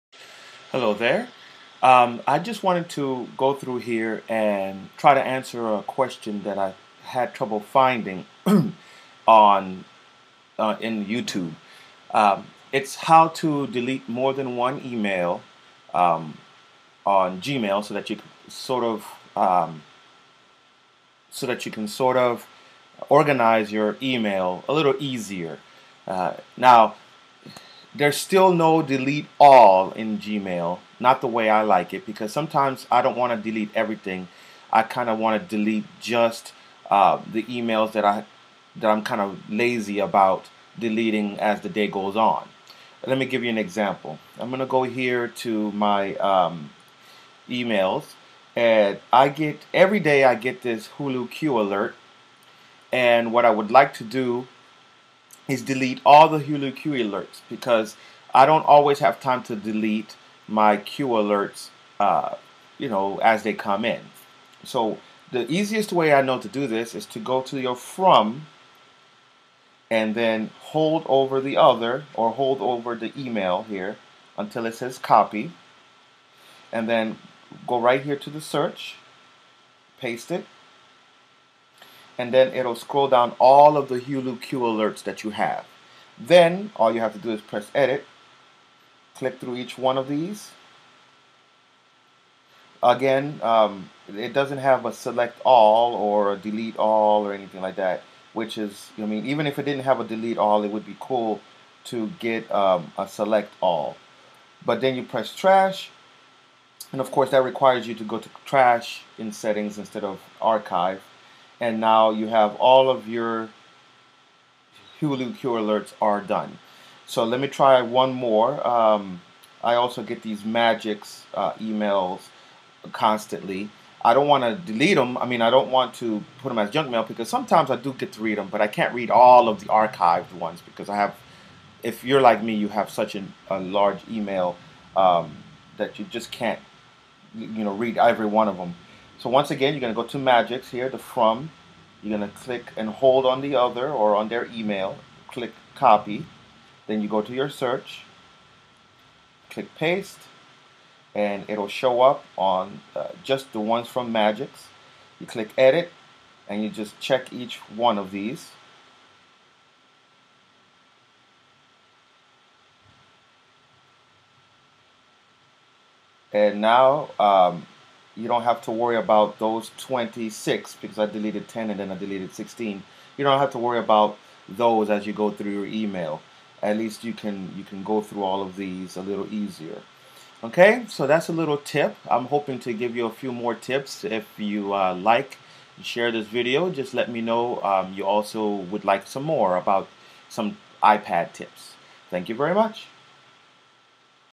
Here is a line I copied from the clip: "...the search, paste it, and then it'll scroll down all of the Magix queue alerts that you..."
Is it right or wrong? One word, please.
wrong.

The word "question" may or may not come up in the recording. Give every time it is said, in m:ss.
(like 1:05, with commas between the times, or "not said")
0:05.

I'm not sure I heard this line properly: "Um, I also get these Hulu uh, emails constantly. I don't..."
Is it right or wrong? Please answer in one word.
wrong.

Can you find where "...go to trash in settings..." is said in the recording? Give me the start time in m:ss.
1:48.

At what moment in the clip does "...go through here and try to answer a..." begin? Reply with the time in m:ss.
0:03.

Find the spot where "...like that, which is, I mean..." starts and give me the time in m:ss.
1:37.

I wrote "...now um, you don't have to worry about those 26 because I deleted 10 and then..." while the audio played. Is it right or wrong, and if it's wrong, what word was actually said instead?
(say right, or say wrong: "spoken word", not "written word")
right.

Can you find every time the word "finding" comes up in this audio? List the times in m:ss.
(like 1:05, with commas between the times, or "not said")
0:07.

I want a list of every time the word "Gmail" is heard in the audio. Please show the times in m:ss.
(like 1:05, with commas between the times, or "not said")
0:17, 0:30.